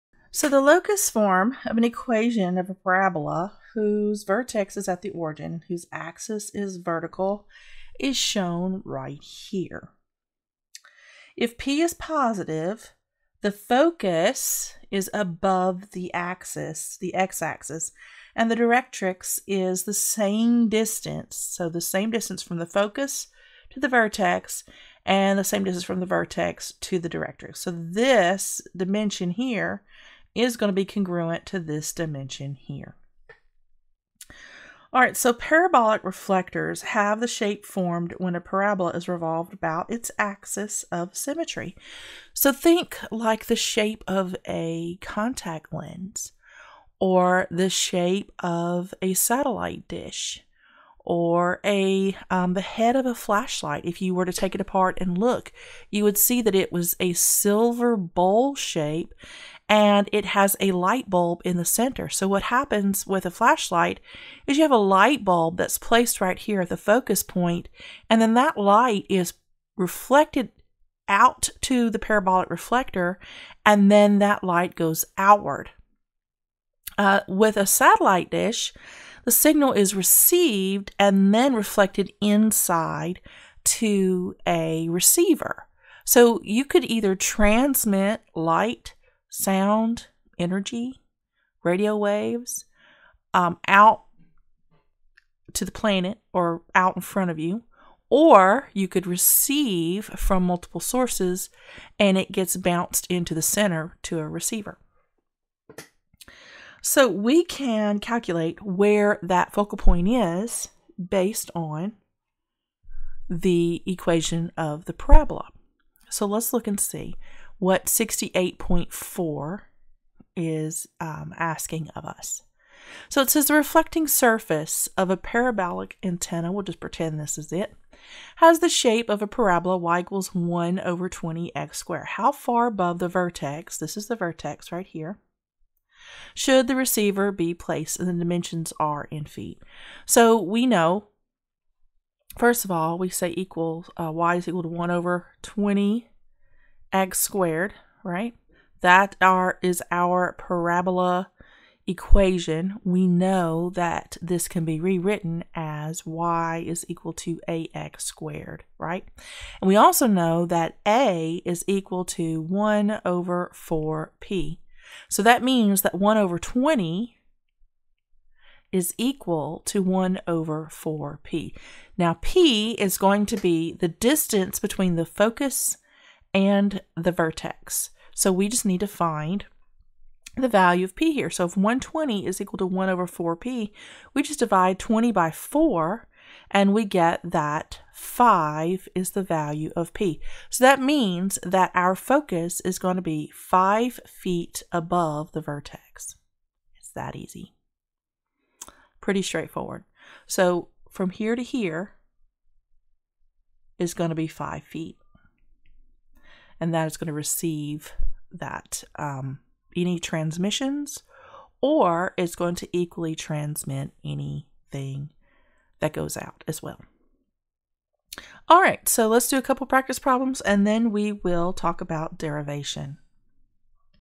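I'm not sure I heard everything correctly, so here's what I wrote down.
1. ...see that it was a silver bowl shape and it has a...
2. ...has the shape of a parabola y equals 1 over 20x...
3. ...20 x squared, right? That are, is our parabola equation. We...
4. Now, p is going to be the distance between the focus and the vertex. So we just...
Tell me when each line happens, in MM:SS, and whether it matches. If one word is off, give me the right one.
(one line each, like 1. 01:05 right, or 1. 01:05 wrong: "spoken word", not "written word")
1. 00:56 right
2. 02:08 right
3. 02:25 right
4. 02:51 right.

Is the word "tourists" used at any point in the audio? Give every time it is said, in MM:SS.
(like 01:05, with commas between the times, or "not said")
not said.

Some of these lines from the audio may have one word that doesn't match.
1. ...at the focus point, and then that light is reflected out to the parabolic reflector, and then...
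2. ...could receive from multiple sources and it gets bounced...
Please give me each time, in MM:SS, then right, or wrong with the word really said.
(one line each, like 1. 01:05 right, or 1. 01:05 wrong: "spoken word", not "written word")
1. 01:06 right
2. 01:38 right.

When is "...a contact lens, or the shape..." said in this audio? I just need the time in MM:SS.
00:44.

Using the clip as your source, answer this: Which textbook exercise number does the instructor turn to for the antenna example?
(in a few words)
68.4.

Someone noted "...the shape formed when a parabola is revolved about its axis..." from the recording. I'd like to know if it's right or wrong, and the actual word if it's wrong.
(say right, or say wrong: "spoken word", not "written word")
right.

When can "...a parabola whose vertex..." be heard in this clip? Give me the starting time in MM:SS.
00:02.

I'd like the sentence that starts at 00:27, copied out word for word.
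So this dimension here is going to be congruent to this dimension here.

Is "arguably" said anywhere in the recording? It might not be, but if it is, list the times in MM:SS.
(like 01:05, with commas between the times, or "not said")
not said.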